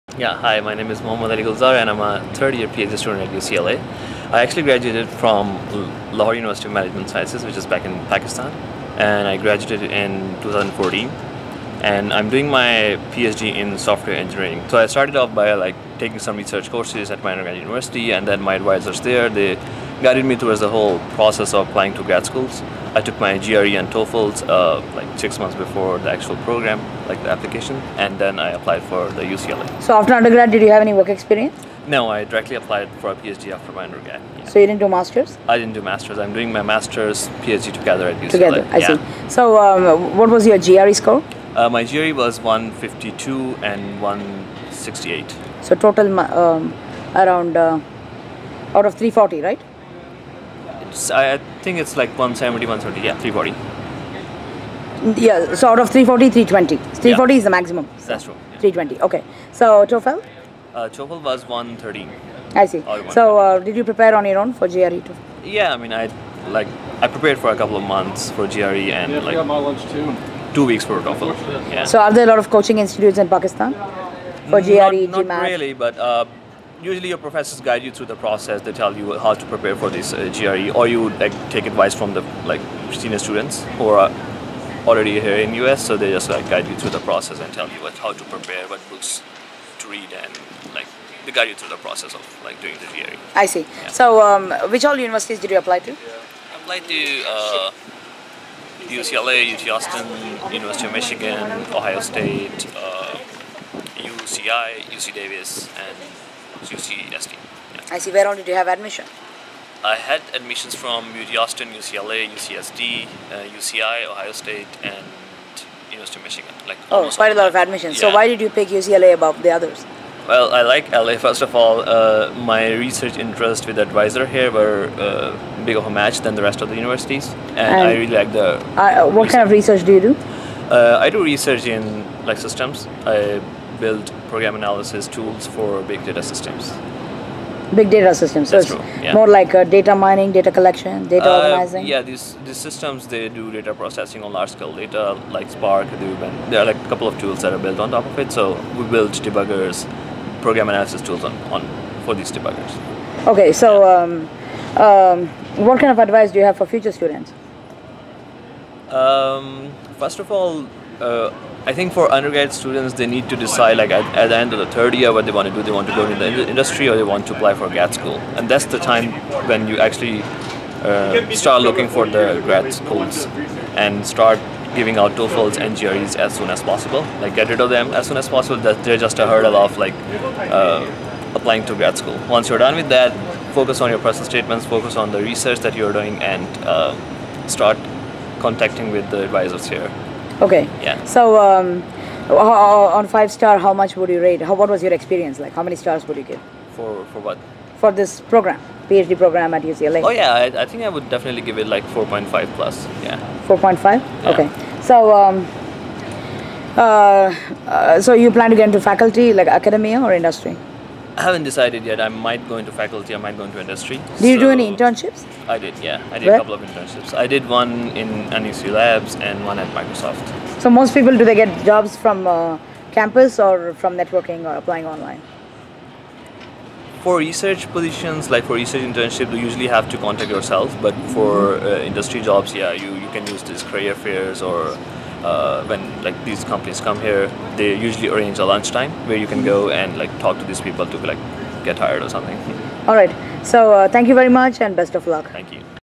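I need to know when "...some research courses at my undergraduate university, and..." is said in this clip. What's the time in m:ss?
0:16.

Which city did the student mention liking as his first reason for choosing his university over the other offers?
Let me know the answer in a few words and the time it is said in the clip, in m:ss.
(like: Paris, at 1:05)
LA, at 2:00.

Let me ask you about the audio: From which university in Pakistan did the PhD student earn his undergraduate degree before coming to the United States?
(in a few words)
Lahore University of Management Sciences.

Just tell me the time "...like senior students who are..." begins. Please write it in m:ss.
1:22.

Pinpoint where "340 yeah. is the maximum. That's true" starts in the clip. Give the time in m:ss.
0:57.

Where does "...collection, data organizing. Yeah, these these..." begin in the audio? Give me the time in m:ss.
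2:20.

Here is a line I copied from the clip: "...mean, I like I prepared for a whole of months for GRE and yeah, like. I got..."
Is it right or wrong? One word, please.
wrong.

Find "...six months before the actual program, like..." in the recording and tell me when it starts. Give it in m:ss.
0:25.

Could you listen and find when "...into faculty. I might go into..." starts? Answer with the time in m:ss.
3:32.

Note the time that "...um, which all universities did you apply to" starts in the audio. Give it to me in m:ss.
1:34.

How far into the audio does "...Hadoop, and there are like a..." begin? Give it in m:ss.
2:25.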